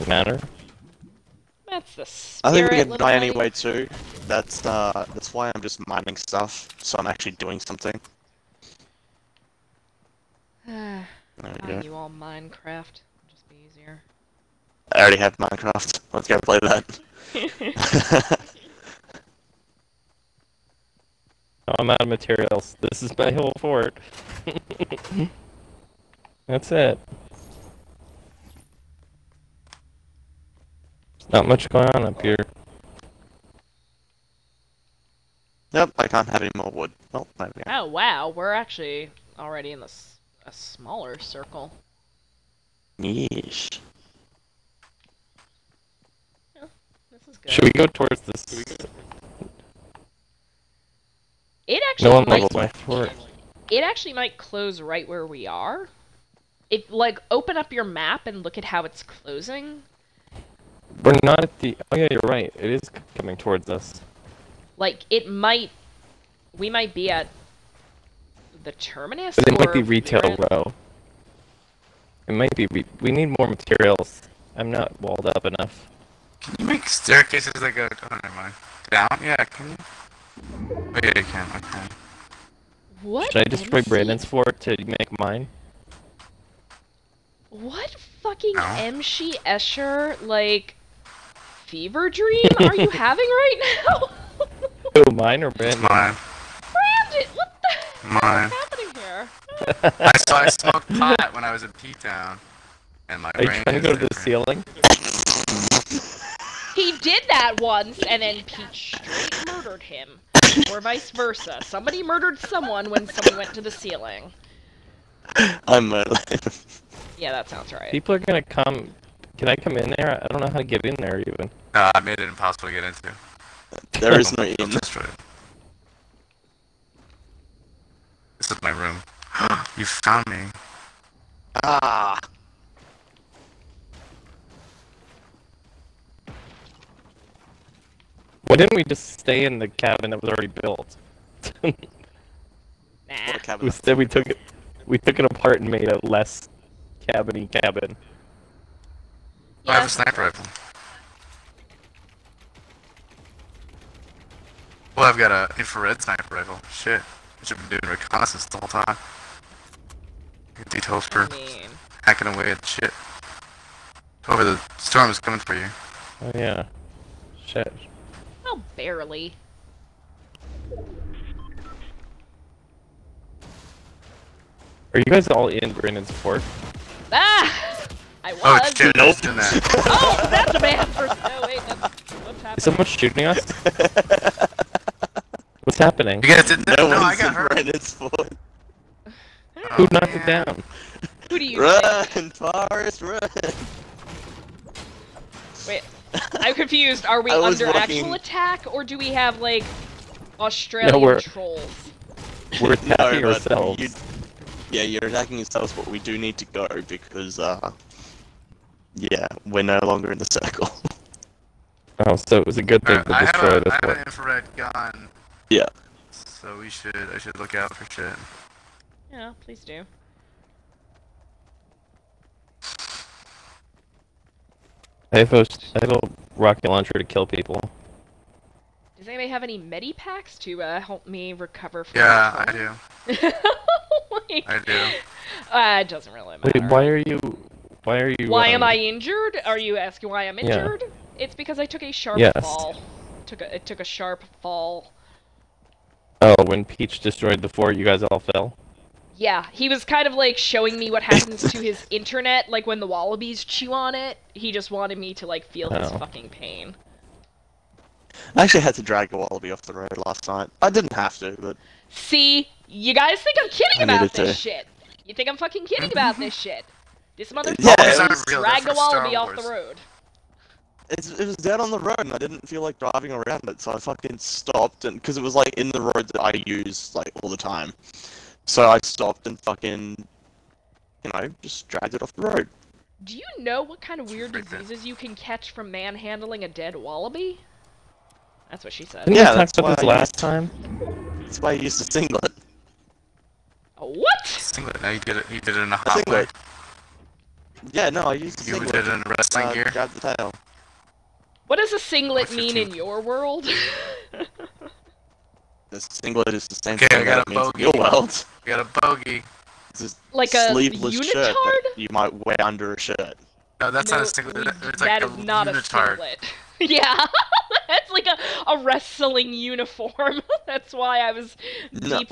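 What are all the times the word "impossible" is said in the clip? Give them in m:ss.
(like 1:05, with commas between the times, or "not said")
2:02.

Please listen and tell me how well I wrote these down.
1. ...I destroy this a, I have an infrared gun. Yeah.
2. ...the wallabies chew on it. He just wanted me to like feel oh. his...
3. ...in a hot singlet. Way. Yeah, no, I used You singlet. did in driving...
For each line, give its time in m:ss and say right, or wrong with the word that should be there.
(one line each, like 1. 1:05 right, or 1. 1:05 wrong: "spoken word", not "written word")
1. 3:33 right
2. 4:12 right
3. 4:55 wrong: "wrestling", not "driving".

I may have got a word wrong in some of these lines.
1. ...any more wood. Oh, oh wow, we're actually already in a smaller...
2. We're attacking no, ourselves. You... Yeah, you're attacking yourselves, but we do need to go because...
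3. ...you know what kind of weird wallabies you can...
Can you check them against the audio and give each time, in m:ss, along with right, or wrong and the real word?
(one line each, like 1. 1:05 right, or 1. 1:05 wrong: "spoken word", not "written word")
1. 0:36 right
2. 3:22 right
3. 4:43 wrong: "diseases", not "wallabies".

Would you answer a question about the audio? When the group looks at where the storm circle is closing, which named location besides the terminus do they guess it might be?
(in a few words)
Retail Row.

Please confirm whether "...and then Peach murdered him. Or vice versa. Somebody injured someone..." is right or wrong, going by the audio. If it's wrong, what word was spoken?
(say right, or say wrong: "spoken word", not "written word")
wrong: "murdered", not "injured".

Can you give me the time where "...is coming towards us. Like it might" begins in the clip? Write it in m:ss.
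1:02.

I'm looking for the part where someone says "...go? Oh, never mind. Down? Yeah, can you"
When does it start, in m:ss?
1:17.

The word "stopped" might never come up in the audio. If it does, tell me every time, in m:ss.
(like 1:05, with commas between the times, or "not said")
4:34, 4:38.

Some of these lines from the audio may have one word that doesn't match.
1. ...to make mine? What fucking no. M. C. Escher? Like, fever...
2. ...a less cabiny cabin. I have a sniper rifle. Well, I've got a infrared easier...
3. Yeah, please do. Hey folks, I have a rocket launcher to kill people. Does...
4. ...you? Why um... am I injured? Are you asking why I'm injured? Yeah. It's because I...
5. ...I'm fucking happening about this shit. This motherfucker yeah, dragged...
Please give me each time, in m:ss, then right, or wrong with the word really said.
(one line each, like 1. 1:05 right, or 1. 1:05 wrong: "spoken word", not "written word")
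1. 1:24 right
2. 2:25 wrong: "sniper", not "easier"
3. 3:39 right
4. 3:58 right
5. 4:25 wrong: "kidding", not "happening".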